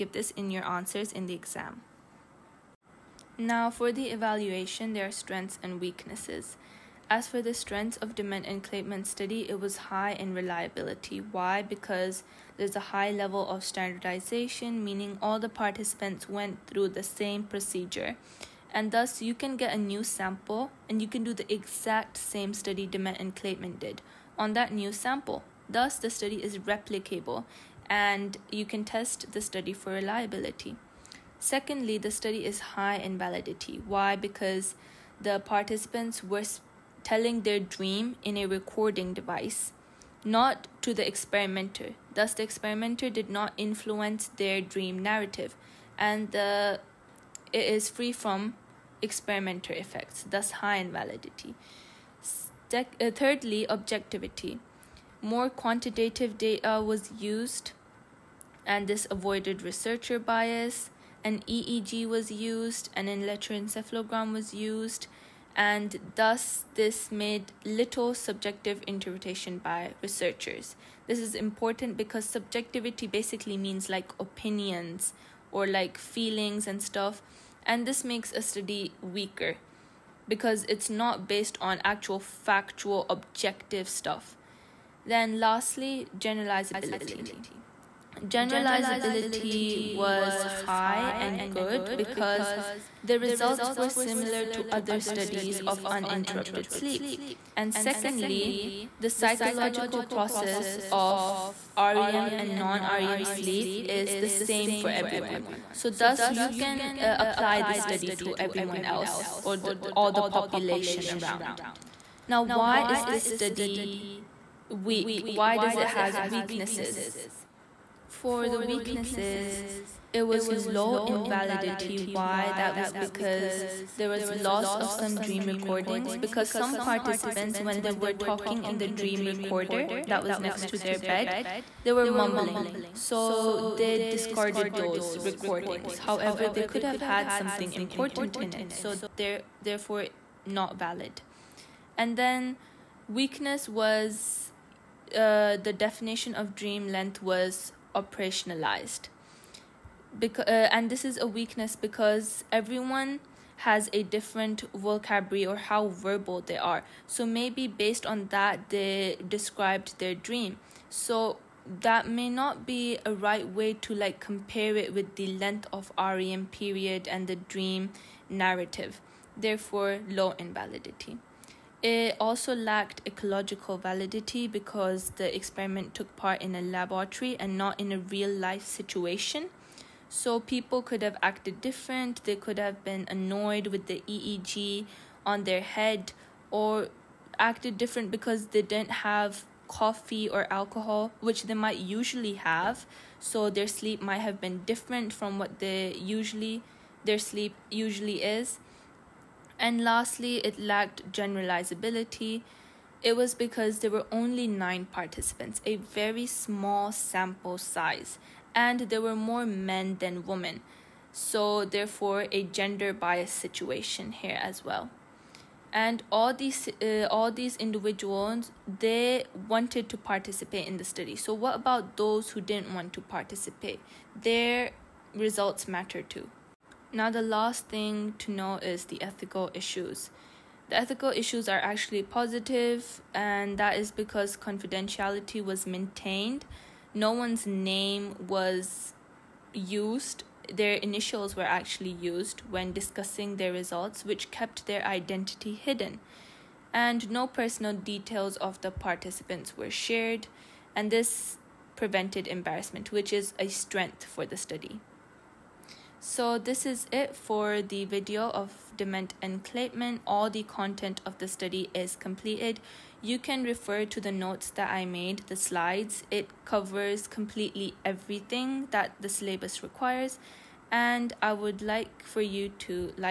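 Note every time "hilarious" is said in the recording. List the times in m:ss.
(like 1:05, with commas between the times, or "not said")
not said.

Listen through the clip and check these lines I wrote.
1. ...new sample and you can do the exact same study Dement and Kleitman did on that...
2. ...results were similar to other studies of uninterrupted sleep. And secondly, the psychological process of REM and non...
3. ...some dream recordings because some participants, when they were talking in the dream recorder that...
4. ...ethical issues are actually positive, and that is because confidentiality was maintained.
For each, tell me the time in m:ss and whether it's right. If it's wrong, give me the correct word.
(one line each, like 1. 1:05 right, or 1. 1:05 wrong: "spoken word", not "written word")
1. 0:19 right
2. 1:33 right
3. 2:04 right
4. 3:50 right.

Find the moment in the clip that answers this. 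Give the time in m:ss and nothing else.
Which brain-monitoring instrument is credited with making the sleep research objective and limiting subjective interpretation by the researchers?
1:03.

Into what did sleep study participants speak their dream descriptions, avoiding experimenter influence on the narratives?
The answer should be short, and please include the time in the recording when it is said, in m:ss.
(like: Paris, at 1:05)
A recording device, at 0:38.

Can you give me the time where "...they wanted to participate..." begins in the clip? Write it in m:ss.
3:38.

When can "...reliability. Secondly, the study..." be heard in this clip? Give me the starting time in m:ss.
0:29.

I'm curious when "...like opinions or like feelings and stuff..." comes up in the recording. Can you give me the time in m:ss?
1:13.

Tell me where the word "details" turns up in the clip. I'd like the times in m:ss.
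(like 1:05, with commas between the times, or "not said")
4:07.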